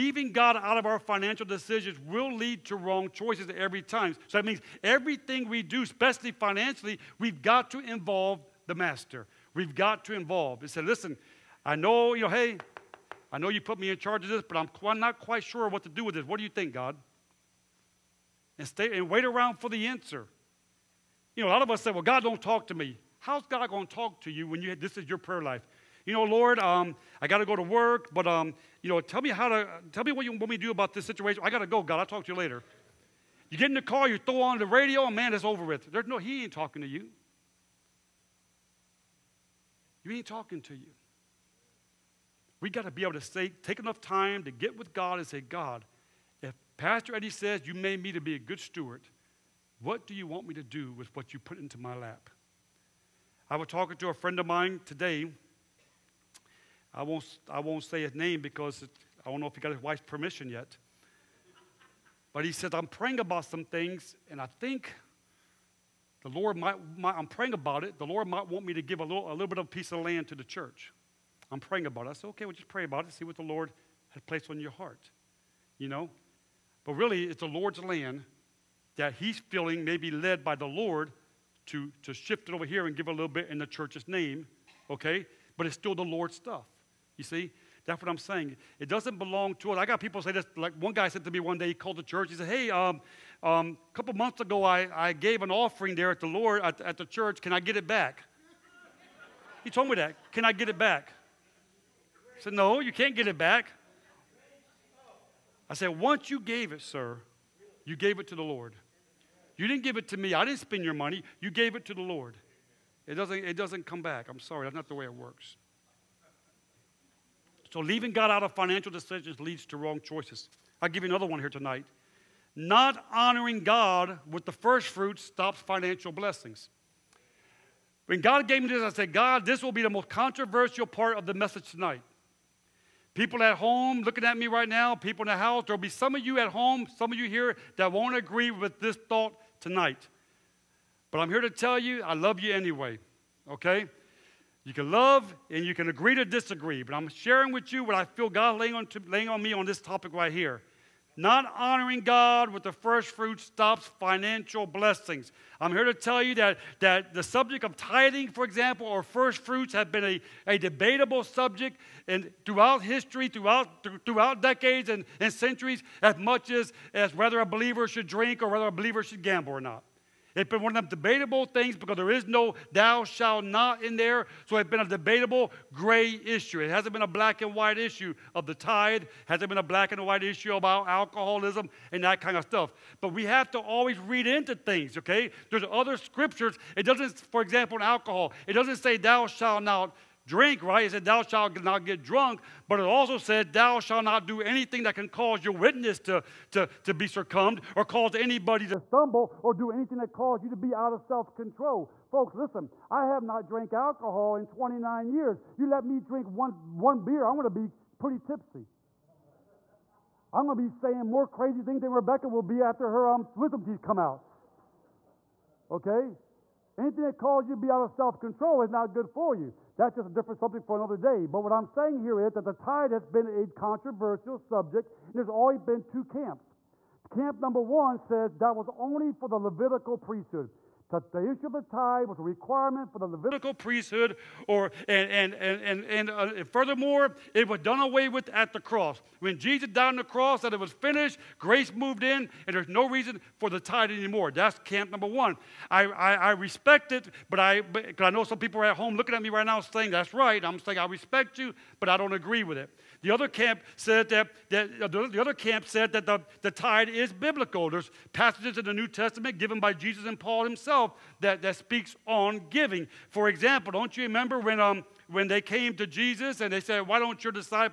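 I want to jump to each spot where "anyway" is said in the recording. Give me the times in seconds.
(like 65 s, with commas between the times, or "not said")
142 s.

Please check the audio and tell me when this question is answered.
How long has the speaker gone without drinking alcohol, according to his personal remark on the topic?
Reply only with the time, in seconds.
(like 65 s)
204 s.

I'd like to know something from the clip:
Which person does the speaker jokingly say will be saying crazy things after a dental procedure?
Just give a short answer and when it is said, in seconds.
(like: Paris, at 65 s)
Rebecca, at 211 s.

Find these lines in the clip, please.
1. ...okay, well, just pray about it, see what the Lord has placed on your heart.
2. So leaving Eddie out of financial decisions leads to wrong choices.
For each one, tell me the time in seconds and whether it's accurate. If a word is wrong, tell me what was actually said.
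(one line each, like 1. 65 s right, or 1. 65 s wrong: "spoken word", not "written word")
1. 72 s right
2. 117 s wrong: "God", not "Eddie".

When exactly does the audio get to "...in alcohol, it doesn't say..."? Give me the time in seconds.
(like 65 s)
187 s.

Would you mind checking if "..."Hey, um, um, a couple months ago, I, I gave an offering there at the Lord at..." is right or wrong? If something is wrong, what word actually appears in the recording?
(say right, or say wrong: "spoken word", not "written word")
right.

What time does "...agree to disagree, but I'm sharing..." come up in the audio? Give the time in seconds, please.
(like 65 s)
145 s.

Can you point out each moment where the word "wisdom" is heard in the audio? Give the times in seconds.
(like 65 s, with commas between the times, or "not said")
213 s.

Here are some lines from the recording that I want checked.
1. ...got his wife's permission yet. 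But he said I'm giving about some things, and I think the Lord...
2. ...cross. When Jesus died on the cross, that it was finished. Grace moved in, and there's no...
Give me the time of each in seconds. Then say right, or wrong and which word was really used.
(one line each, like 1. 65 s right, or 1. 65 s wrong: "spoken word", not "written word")
1. 59 s wrong: "praying", not "giving"
2. 238 s right.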